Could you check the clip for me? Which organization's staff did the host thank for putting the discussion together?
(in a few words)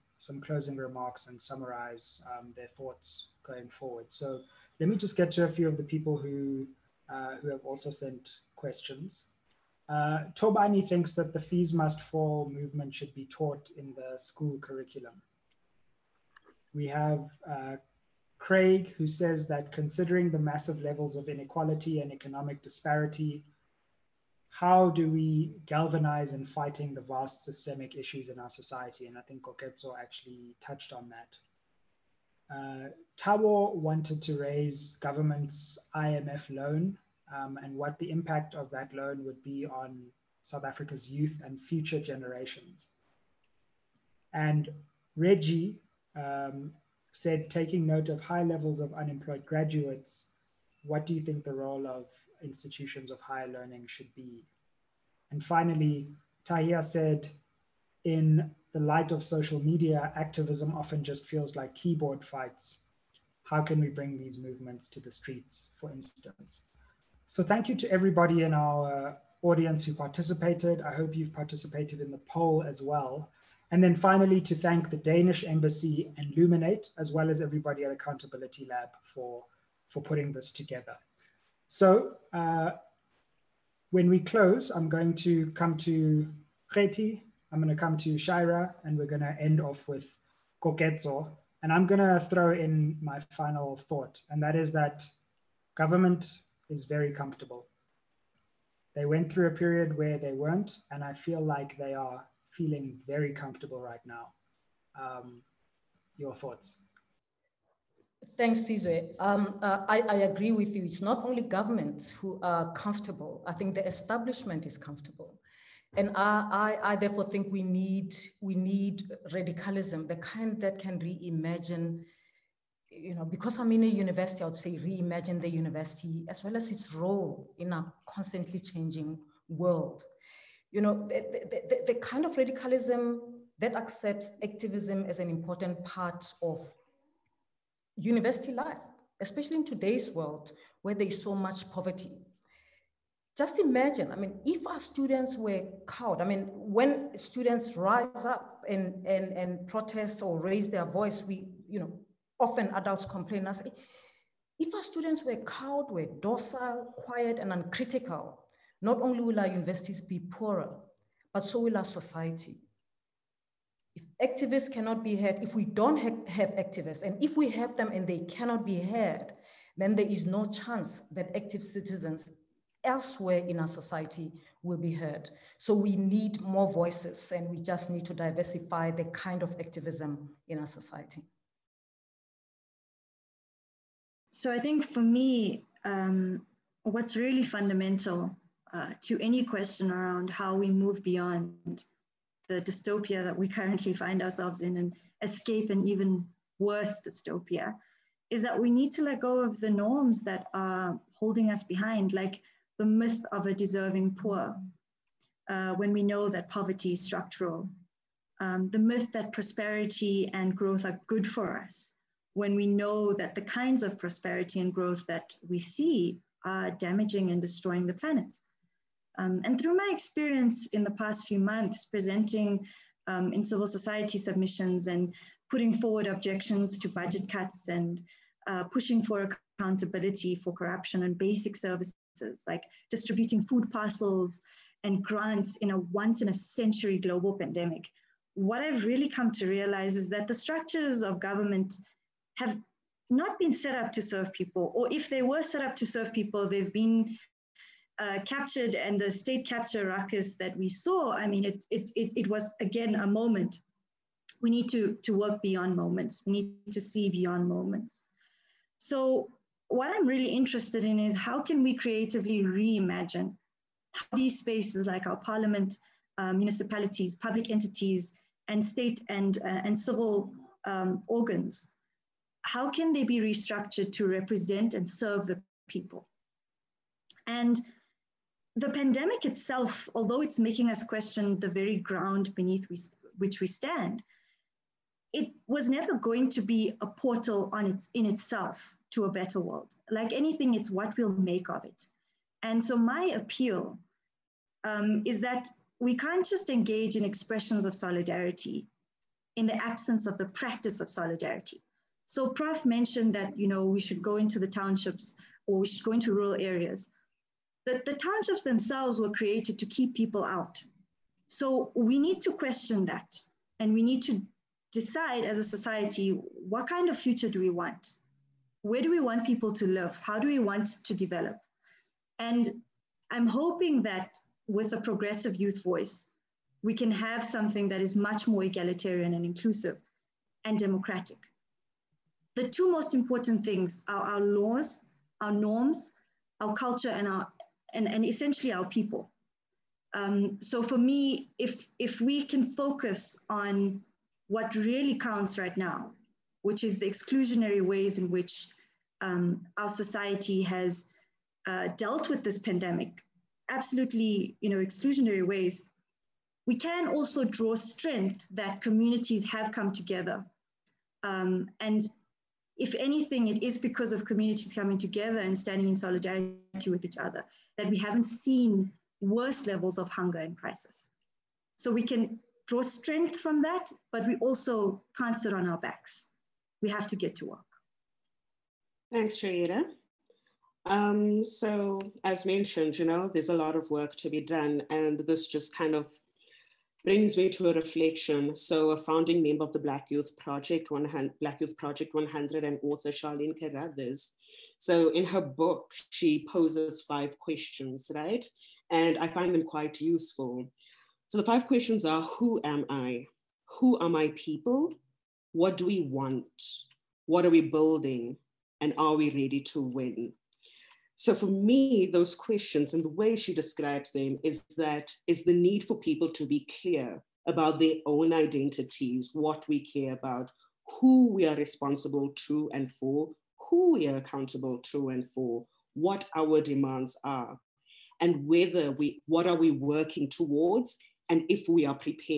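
Accountability Lab.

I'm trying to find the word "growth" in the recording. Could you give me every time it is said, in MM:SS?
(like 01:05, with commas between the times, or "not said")
03:30, 03:34.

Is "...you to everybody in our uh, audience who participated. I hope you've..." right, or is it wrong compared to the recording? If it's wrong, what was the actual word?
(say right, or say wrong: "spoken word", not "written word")
right.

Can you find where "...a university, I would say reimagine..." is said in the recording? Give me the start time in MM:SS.
02:03.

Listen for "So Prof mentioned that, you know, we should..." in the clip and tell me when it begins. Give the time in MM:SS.
05:02.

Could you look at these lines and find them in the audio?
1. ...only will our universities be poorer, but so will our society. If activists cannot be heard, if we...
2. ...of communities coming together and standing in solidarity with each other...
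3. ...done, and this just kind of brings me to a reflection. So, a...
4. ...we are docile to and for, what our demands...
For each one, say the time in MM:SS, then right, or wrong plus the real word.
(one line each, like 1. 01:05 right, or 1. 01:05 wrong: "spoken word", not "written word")
1. 02:39 right
2. 06:03 right
3. 06:24 right
4. 07:03 wrong: "accountable", not "docile".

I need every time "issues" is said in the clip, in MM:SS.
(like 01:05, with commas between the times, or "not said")
00:27.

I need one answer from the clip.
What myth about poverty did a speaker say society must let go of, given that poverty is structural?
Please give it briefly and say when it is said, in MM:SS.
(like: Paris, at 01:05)
deserving poor, at 03:22.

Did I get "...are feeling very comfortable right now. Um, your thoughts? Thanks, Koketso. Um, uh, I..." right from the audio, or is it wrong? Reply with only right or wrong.
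wrong.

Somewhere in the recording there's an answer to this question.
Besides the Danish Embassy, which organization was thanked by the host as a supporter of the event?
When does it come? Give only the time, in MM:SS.
01:16.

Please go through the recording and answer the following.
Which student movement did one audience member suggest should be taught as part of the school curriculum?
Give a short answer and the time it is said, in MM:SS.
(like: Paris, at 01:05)
Fees Must Fall, at 00:11.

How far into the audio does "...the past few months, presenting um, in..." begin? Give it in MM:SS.
03:40.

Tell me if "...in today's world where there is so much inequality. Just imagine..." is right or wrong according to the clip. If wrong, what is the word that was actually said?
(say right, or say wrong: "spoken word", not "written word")
wrong: "poverty", not "inequality".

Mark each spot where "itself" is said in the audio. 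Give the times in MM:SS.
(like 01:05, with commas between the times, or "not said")
04:39, 04:48.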